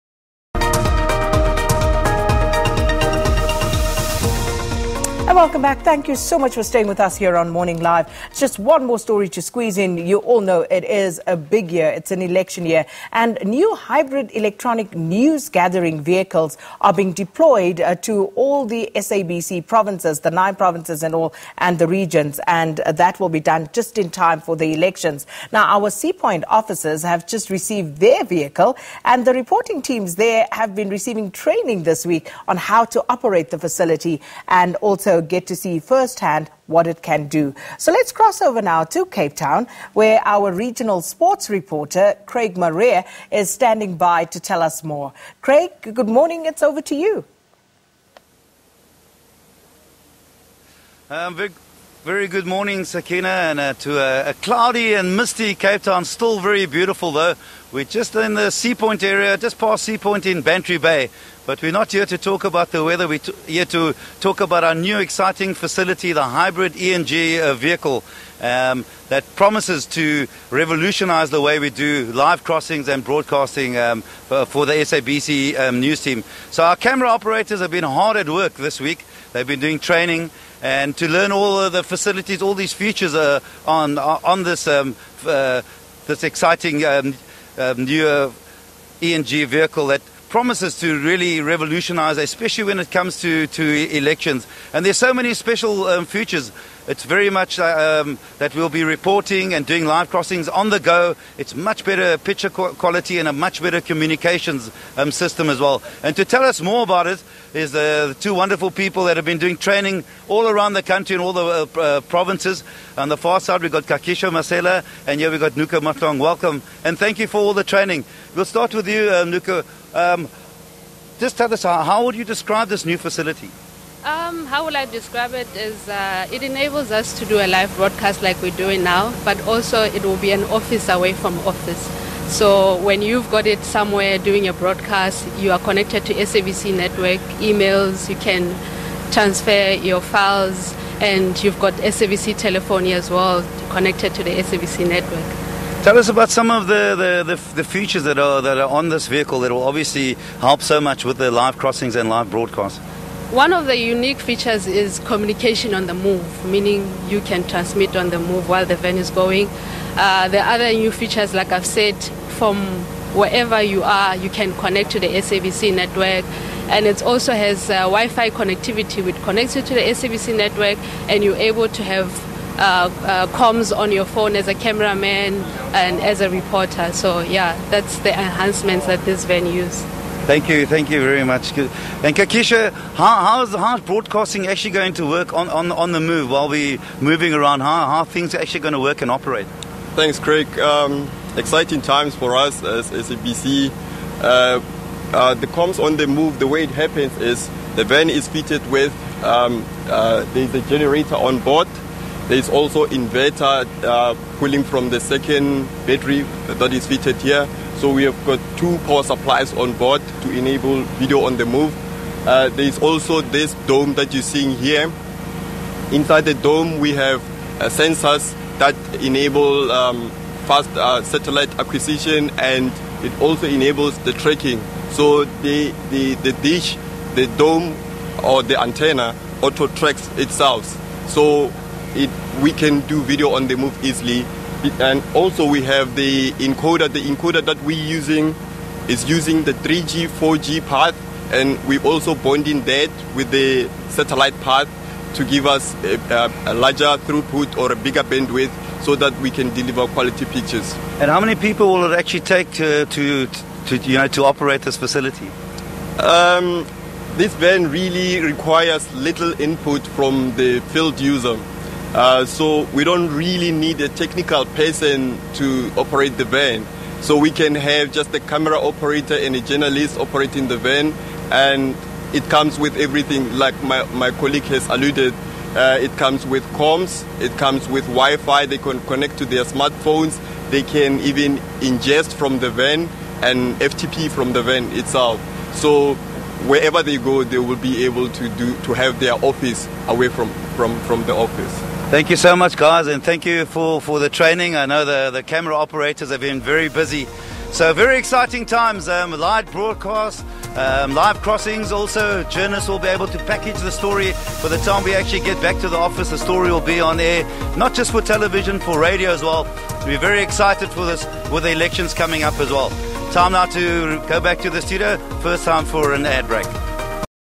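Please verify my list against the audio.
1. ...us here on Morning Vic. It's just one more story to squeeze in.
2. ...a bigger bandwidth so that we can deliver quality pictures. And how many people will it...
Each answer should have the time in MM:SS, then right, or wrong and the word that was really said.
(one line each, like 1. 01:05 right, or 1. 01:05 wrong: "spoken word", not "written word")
1. 00:06 wrong: "Live", not "Vic"
2. 04:07 right.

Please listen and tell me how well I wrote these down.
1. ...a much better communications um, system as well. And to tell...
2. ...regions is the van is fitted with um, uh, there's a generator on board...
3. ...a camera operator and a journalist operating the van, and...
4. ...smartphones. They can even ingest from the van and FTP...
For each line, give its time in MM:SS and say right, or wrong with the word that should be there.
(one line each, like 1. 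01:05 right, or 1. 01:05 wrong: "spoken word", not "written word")
1. 01:43 right
2. 03:16 wrong: "happens", not "regions"
3. 04:28 right
4. 04:39 right.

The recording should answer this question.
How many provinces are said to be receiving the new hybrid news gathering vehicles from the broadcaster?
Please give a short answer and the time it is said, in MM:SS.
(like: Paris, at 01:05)
9, at 00:20.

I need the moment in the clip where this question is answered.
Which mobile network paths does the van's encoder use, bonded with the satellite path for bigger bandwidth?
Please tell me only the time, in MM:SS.
03:59.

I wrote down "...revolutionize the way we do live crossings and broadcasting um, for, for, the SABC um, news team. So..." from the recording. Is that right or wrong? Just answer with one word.
right.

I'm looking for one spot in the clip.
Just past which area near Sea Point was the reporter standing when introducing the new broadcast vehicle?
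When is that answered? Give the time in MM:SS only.
01:00.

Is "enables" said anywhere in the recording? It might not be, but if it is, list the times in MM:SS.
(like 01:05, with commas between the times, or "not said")
02:06, 03:30, 03:39, 03:43.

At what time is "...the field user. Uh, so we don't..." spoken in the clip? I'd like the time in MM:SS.
04:20.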